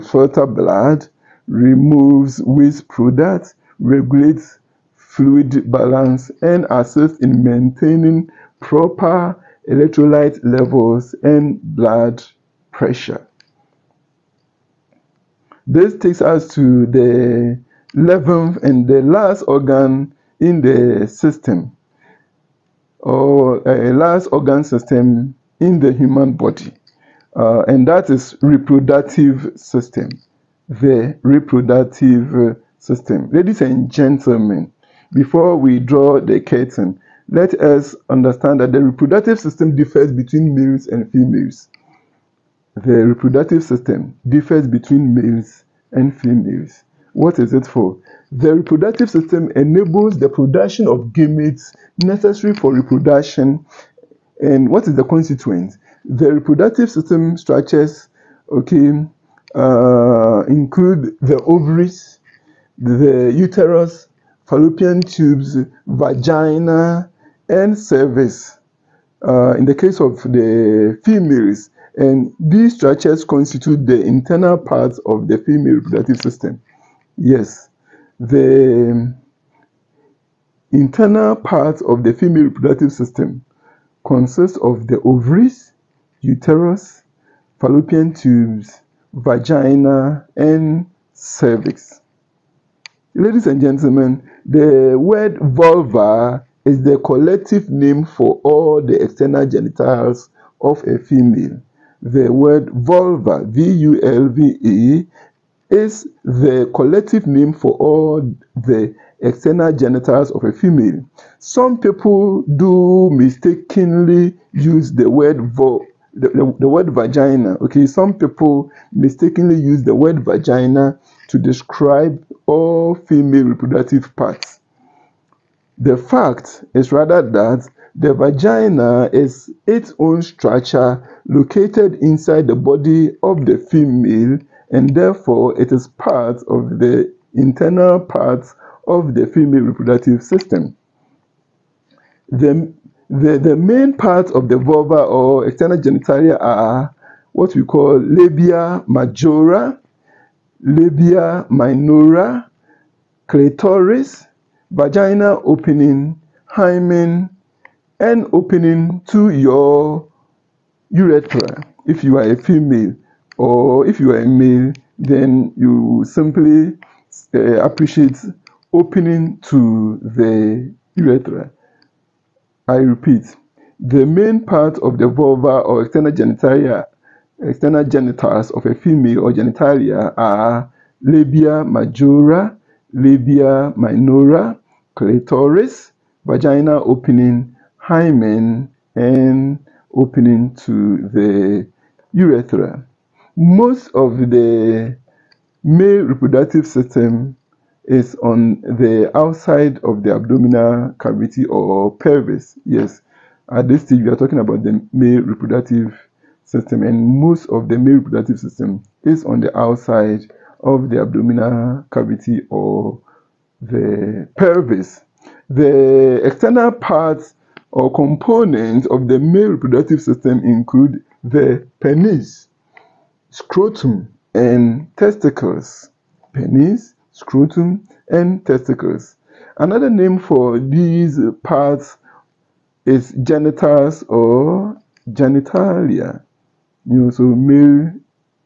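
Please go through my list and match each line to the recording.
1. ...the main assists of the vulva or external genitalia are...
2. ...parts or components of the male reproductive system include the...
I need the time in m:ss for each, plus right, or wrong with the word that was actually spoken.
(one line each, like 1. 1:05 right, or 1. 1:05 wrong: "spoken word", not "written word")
1. 2:23 wrong: "parts", not "assists"
2. 3:36 right.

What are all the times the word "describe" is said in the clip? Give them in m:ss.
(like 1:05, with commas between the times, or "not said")
2:01.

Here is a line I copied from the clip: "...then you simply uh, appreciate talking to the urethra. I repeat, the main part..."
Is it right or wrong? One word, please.
wrong.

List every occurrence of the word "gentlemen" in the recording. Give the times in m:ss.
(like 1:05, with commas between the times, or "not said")
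0:33, 1:33.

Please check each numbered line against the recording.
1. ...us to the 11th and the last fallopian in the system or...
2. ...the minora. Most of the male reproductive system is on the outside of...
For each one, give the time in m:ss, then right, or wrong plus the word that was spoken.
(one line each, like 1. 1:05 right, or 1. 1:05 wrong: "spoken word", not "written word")
1. 0:16 wrong: "organ", not "fallopian"
2. 3:11 wrong: "urethra", not "minora".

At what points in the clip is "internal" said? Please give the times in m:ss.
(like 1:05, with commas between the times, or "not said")
1:14, 1:20, 2:17.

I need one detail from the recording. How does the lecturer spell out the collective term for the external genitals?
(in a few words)
V-U-L-V-E.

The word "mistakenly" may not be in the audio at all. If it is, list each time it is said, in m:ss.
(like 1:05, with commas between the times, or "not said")
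1:53, 1:58.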